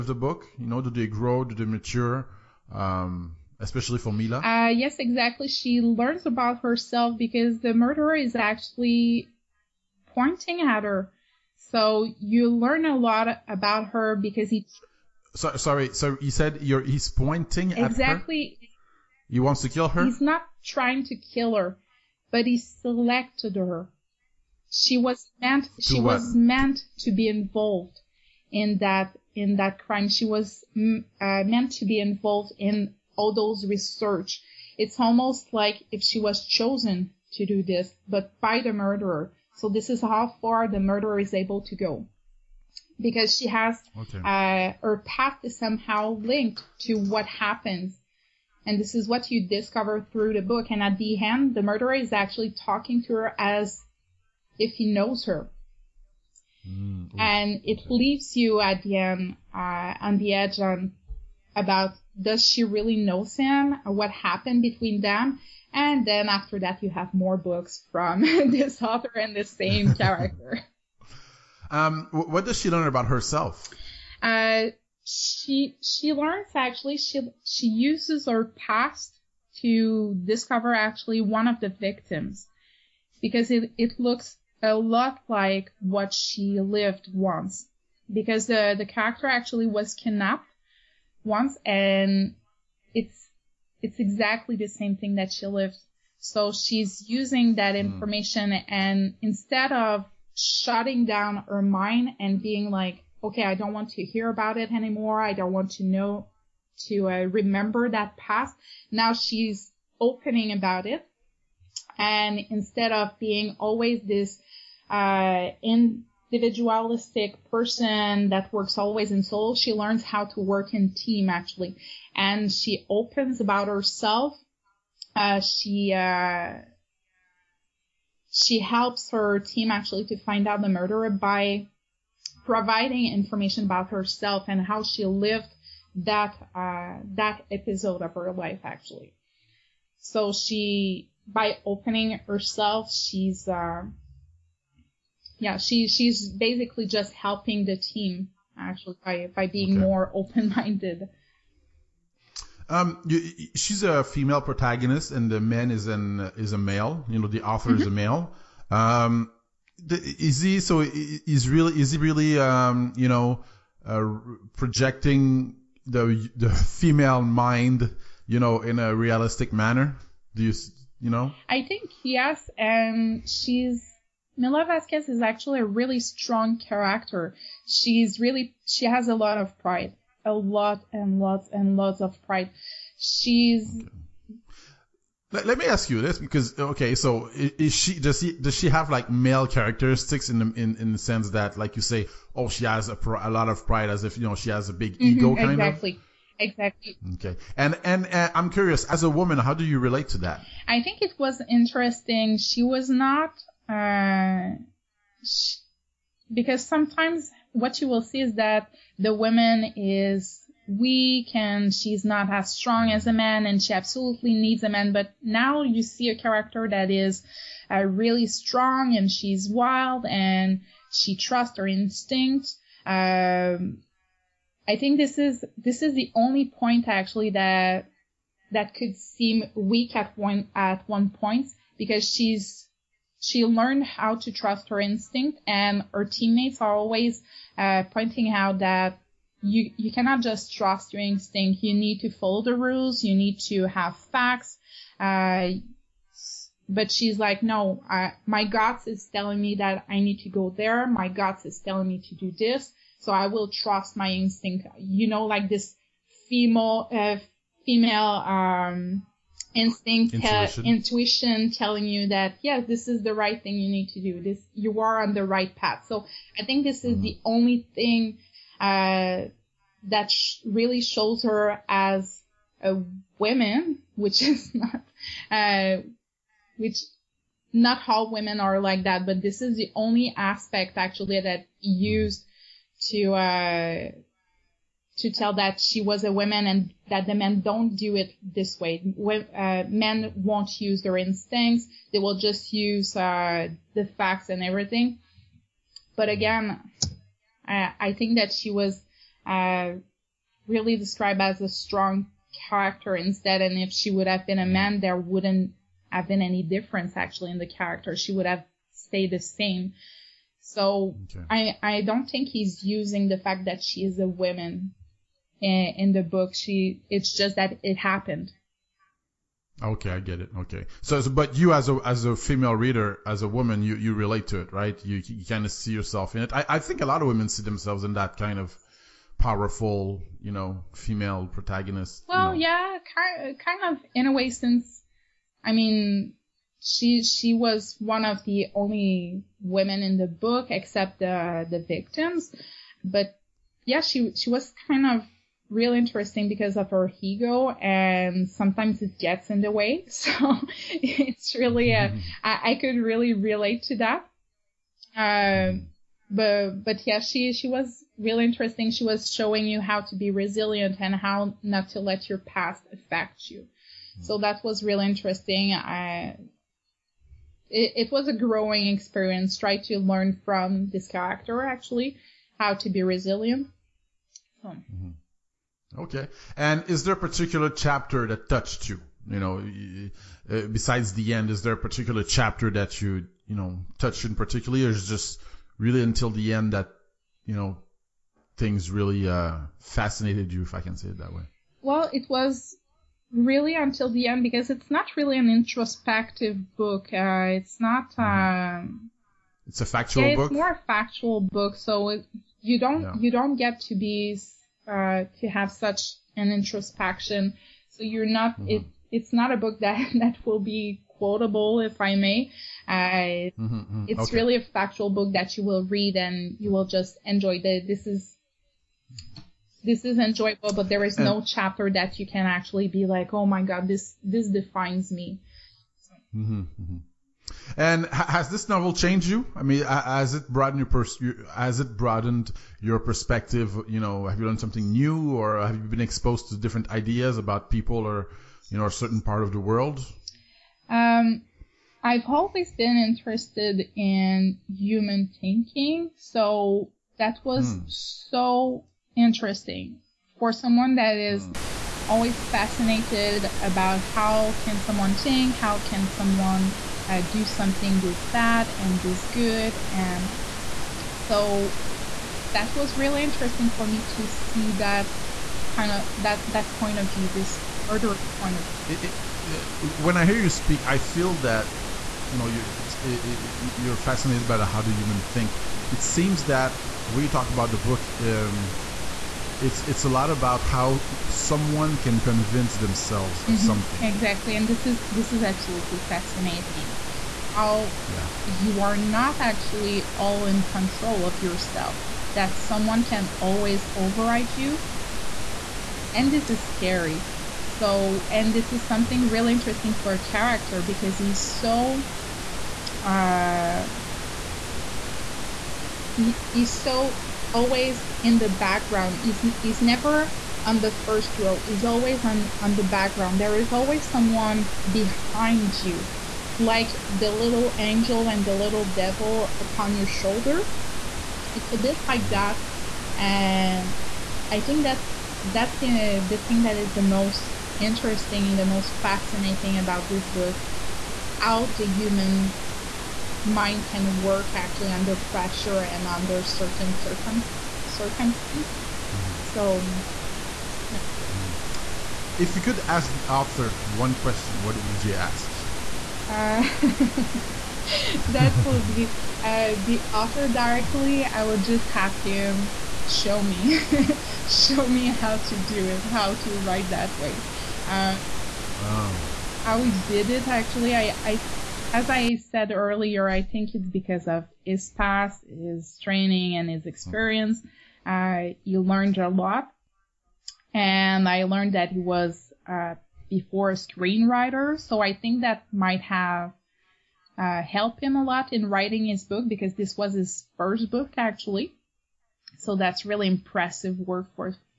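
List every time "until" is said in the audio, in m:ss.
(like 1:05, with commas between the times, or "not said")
6:25, 6:33.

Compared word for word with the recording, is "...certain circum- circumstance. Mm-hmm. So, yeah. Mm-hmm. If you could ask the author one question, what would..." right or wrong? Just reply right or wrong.
right.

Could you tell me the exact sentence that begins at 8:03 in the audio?
something exactly and this is this is absolutely fascinating how yeah.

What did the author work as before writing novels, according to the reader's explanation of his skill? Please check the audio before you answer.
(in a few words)
screenwriter.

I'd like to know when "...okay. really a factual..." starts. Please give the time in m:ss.
6:54.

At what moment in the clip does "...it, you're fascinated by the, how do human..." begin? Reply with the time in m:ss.
7:52.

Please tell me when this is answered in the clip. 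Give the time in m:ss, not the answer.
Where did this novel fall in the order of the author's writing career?
9:39.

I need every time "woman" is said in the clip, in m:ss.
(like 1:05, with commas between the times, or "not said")
3:19, 3:29, 4:33, 4:46, 5:14, 5:23.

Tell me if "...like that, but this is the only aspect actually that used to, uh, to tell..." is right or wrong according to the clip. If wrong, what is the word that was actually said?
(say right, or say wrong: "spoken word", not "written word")
right.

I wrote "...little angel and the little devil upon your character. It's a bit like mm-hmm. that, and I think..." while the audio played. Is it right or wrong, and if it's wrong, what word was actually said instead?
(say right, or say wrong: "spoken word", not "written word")
wrong: "shoulder", not "character".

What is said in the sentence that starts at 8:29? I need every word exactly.
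Is is never on the first row.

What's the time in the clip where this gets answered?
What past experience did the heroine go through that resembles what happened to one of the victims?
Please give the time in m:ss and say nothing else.
1:29.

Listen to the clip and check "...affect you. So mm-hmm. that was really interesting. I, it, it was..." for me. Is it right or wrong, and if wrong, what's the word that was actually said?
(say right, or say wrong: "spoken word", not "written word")
right.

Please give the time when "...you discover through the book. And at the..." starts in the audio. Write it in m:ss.
0:49.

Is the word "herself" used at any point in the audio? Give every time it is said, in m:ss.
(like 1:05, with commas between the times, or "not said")
0:06, 1:13, 2:03, 2:13, 2:22.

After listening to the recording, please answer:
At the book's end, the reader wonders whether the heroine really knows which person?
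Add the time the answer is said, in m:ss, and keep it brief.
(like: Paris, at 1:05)
Sam, at 1:03.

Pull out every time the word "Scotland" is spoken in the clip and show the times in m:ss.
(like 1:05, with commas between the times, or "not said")
not said.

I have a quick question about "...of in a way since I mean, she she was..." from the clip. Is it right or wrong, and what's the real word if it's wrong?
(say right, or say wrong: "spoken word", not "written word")
right.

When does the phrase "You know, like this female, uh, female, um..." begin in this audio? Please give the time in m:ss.
4:14.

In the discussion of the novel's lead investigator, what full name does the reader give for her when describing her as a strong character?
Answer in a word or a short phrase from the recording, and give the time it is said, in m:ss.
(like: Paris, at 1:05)
Mila Vasquez, at 2:54.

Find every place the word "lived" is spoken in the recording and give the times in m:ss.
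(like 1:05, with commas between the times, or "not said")
1:26, 1:35, 2:15.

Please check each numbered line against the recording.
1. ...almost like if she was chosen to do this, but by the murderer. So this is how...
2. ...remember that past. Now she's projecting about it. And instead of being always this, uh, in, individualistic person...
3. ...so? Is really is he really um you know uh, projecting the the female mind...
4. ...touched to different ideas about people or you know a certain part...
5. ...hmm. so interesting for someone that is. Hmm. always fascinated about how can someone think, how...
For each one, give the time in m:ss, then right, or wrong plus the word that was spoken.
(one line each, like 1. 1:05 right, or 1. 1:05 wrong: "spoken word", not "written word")
1. 0:34 right
2. 1:47 wrong: "opening", not "projecting"
3. 2:40 right
4. 7:15 wrong: "exposed", not "touched"
5. 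7:27 right.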